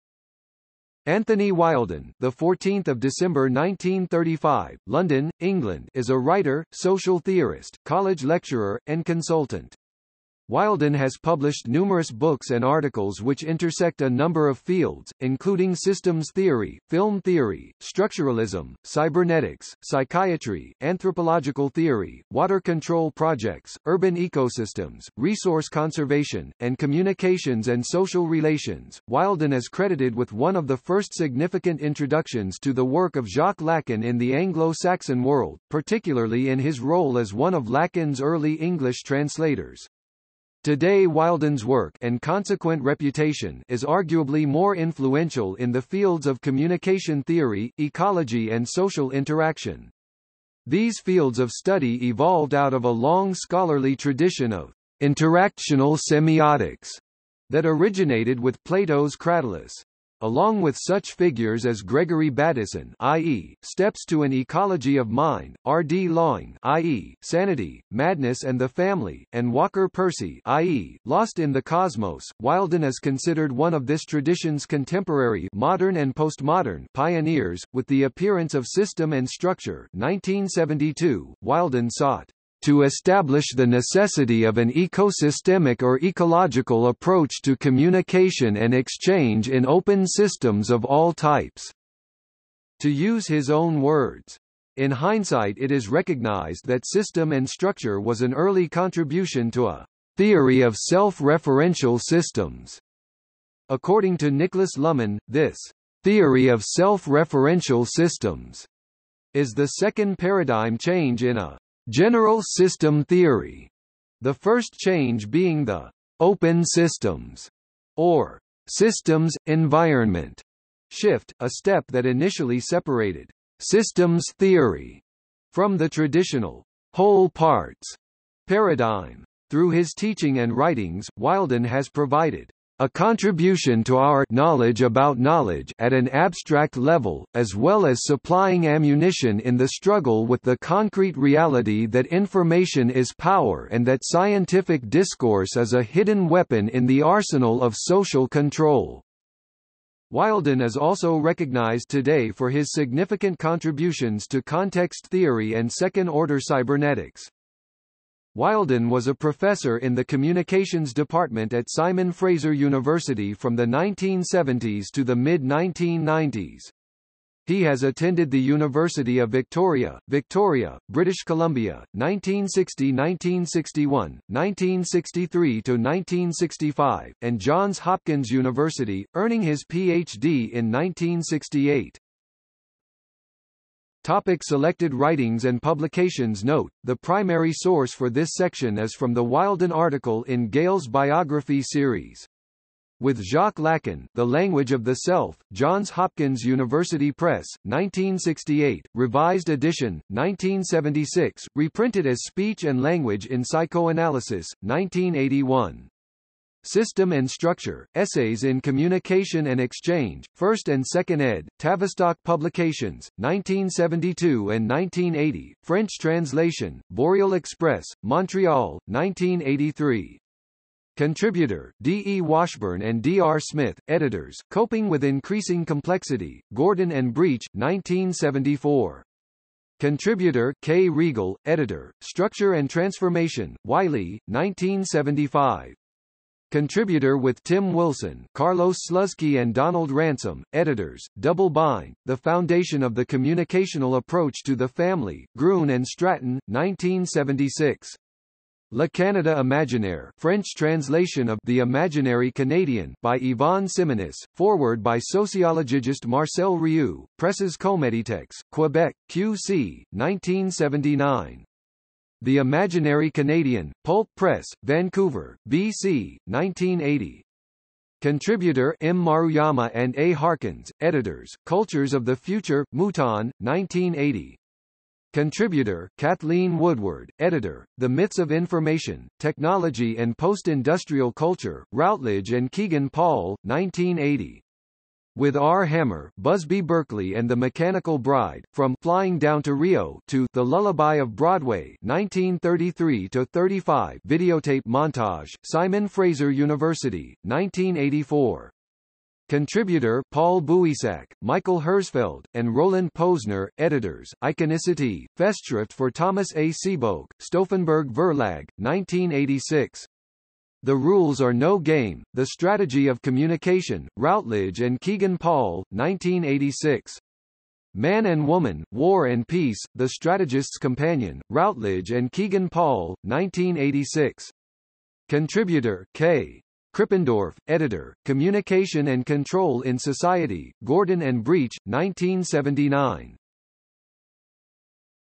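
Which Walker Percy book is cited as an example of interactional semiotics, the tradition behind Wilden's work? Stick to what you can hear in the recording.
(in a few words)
Lost in the Cosmos.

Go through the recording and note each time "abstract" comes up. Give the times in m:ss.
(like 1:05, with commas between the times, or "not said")
2:16.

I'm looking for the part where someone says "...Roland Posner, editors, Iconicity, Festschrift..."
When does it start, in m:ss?
5:02.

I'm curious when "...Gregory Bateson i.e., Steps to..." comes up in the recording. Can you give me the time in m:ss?
1:01.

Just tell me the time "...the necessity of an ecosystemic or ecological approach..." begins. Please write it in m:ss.
1:23.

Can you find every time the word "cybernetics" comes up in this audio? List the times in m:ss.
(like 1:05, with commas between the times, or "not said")
0:18, 2:36.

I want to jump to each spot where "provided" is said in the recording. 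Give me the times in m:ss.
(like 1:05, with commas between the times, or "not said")
2:11.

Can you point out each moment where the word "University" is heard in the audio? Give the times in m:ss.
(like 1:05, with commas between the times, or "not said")
2:42, 2:48, 2:58, 3:16, 4:56.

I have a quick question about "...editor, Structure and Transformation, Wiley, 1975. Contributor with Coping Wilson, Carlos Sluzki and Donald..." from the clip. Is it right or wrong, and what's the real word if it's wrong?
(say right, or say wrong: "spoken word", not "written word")
wrong: "Tim", not "Coping".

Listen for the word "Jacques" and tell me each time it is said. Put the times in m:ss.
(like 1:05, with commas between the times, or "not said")
0:33, 3:13.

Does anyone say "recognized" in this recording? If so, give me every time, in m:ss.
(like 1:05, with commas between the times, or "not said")
1:35, 2:31.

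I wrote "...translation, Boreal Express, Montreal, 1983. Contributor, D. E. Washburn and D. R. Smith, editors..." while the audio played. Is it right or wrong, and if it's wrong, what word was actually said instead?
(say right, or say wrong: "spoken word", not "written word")
right.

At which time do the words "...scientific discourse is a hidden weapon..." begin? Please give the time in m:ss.
2:24.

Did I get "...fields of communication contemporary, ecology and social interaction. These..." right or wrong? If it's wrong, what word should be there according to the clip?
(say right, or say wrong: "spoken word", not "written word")
wrong: "theory", not "contemporary".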